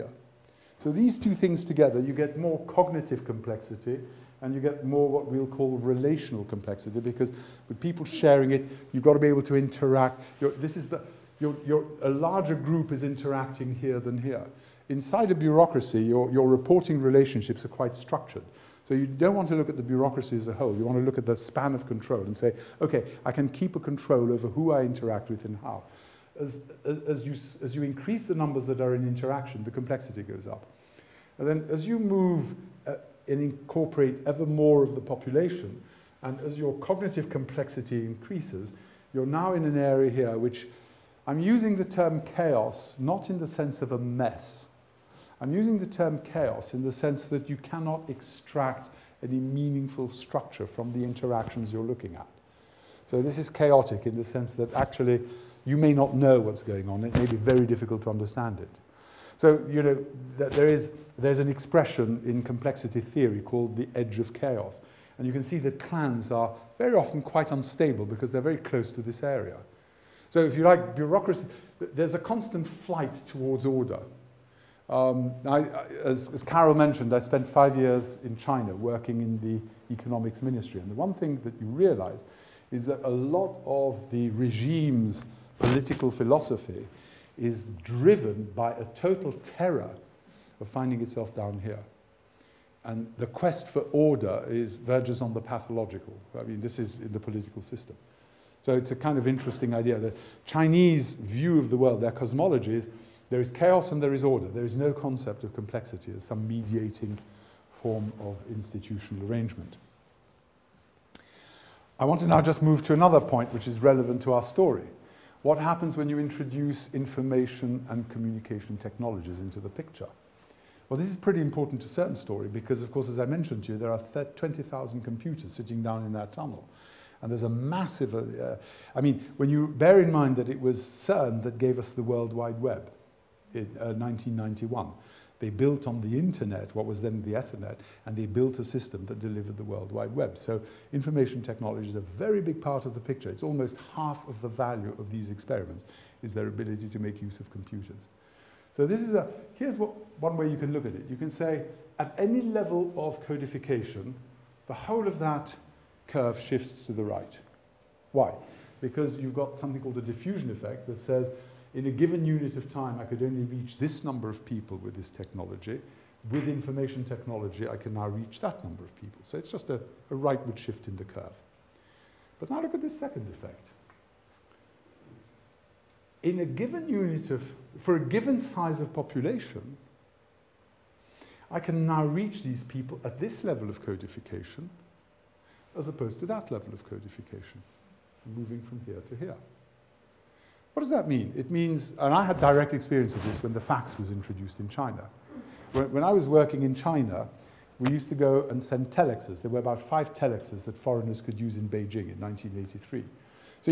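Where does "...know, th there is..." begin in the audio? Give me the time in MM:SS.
00:59.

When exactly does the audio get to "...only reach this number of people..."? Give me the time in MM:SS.
02:43.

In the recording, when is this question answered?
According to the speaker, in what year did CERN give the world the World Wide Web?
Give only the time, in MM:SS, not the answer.
02:13.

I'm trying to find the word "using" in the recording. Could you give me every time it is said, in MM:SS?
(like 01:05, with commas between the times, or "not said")
00:41, 00:45.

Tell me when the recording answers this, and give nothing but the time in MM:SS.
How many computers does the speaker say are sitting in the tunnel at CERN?
02:04.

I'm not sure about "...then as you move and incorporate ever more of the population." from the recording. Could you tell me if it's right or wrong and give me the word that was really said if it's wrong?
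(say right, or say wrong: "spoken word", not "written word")
right.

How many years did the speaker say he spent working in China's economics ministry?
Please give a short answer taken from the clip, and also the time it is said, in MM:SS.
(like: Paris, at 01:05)
5, at 01:17.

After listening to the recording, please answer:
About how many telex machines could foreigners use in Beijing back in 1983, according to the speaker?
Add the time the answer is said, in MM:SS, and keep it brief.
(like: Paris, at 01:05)
5, at 03:19.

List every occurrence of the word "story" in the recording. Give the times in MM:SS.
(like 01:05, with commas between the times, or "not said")
01:54, 02:02.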